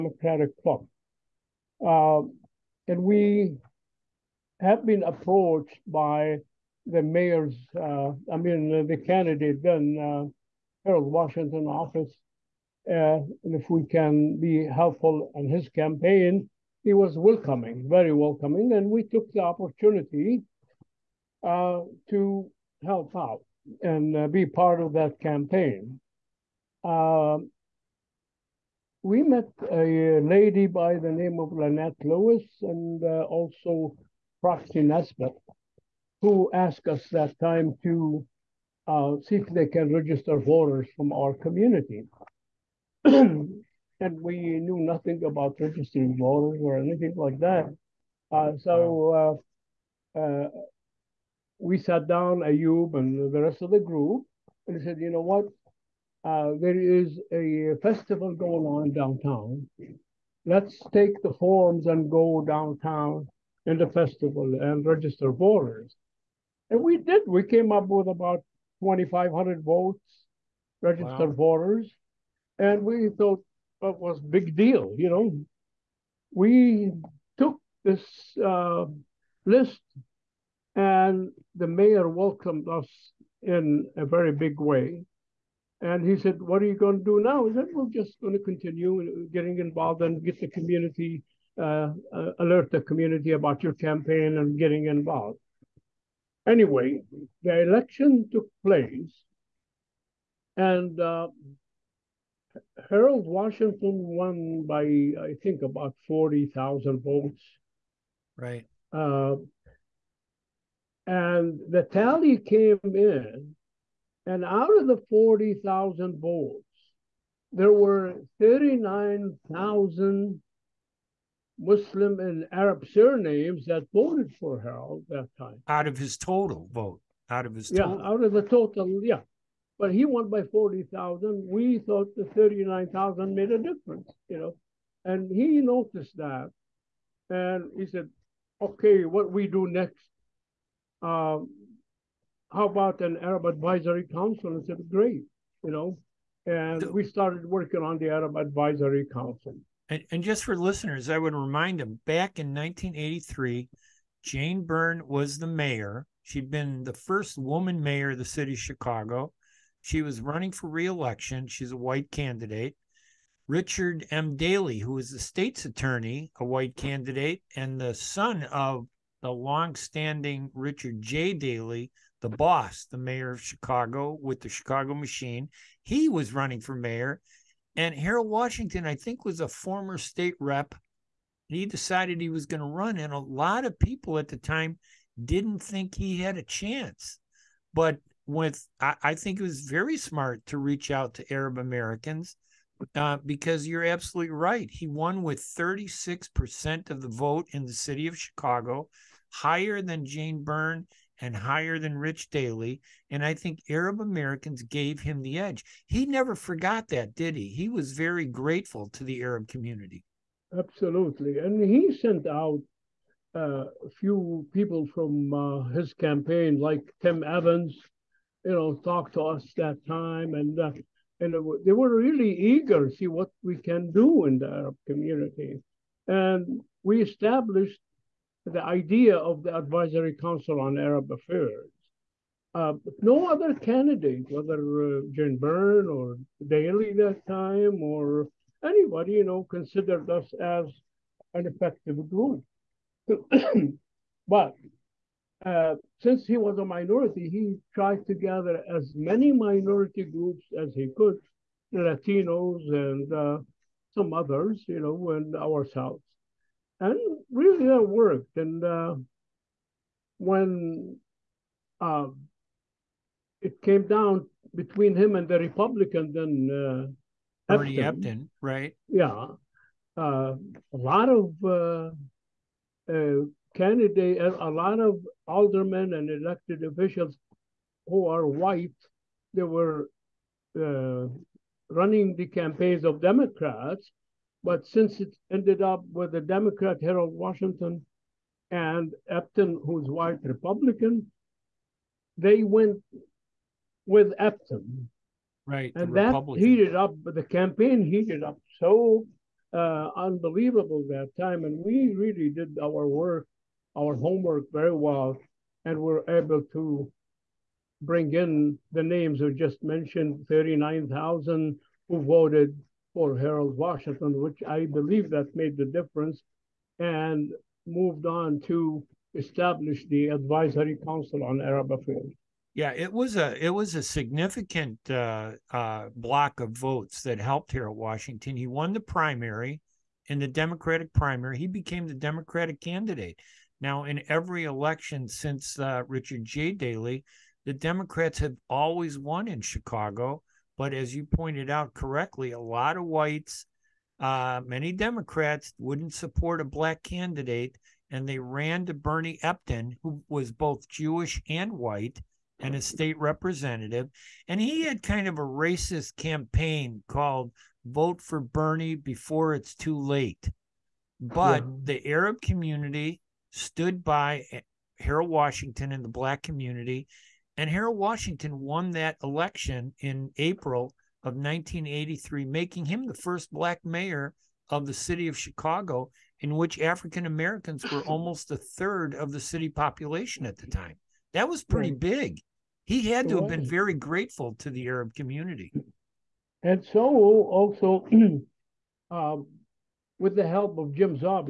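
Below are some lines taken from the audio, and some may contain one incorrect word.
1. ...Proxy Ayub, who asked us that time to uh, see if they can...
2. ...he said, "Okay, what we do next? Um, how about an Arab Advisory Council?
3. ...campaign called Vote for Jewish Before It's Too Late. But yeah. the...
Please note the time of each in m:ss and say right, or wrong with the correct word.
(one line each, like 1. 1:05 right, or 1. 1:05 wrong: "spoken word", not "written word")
1. 0:34 wrong: "Nesbitt", not "Ayub"
2. 2:17 right
3. 5:55 wrong: "Bernie", not "Jewish".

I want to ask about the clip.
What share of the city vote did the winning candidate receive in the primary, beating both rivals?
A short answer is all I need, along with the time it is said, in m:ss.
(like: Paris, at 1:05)
36%, at 3:15.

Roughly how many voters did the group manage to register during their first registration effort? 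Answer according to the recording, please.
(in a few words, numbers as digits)
2,500.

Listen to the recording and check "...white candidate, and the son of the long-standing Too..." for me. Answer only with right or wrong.
wrong.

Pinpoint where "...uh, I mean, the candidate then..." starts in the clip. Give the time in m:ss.
0:07.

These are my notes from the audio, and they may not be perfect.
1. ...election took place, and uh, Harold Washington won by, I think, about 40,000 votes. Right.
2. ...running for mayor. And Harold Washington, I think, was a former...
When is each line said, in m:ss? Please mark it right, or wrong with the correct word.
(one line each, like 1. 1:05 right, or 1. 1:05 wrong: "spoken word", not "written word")
1. 1:37 right
2. 2:56 right.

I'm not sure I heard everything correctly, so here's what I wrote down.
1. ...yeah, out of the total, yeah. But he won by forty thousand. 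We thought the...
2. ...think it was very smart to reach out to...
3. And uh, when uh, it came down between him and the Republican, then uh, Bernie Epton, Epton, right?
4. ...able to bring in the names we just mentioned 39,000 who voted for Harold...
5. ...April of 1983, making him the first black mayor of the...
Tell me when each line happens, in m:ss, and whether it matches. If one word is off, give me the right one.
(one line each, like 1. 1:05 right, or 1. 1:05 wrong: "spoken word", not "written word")
1. 2:07 right
2. 3:09 right
3. 4:18 right
4. 5:06 right
5. 6:10 right.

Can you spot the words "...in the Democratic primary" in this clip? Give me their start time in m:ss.
5:30.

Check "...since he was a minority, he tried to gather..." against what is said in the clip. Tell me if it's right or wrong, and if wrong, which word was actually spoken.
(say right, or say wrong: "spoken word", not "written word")
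right.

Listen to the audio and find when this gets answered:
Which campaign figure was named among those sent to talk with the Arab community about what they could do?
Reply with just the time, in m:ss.
3:37.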